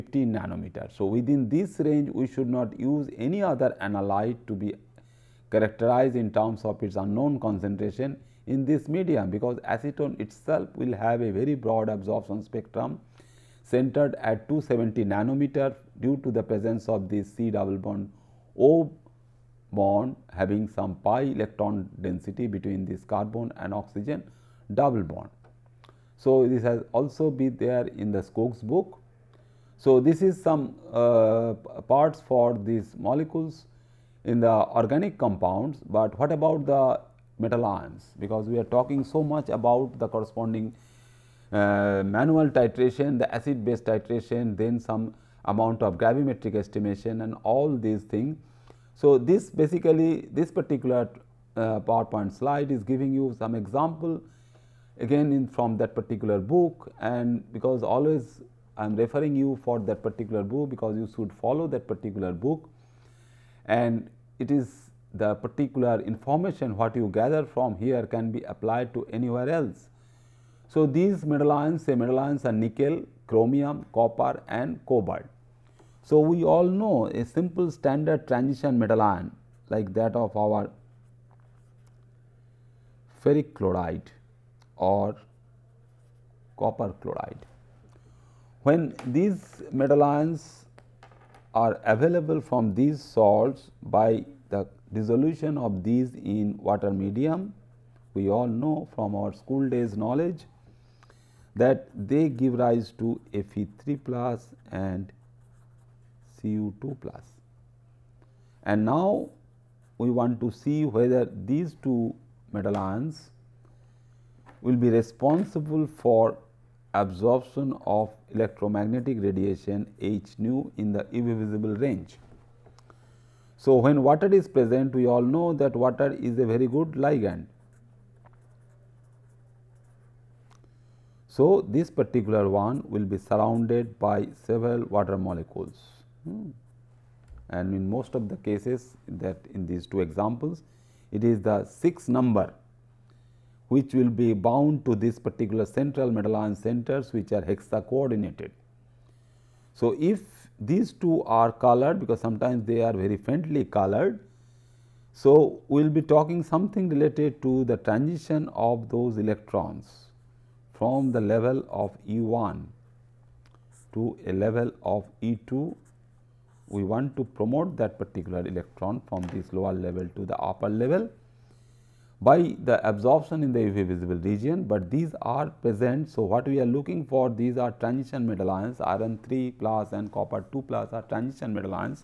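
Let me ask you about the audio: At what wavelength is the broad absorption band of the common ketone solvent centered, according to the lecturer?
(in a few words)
270 nanometers.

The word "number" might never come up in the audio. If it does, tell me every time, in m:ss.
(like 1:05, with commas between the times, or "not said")
2:22.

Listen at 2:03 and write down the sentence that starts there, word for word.
So, when water is present we all know that water is a very good ligand.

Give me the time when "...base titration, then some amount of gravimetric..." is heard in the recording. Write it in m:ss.
0:43.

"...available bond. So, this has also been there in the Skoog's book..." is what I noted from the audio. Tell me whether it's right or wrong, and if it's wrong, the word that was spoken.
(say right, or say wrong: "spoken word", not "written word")
wrong: "double", not "available".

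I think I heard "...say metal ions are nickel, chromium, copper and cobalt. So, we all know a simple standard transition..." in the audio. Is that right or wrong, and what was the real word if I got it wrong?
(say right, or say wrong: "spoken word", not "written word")
right.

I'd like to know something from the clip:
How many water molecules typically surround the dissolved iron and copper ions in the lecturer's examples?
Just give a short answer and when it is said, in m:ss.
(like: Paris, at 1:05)
6, at 2:21.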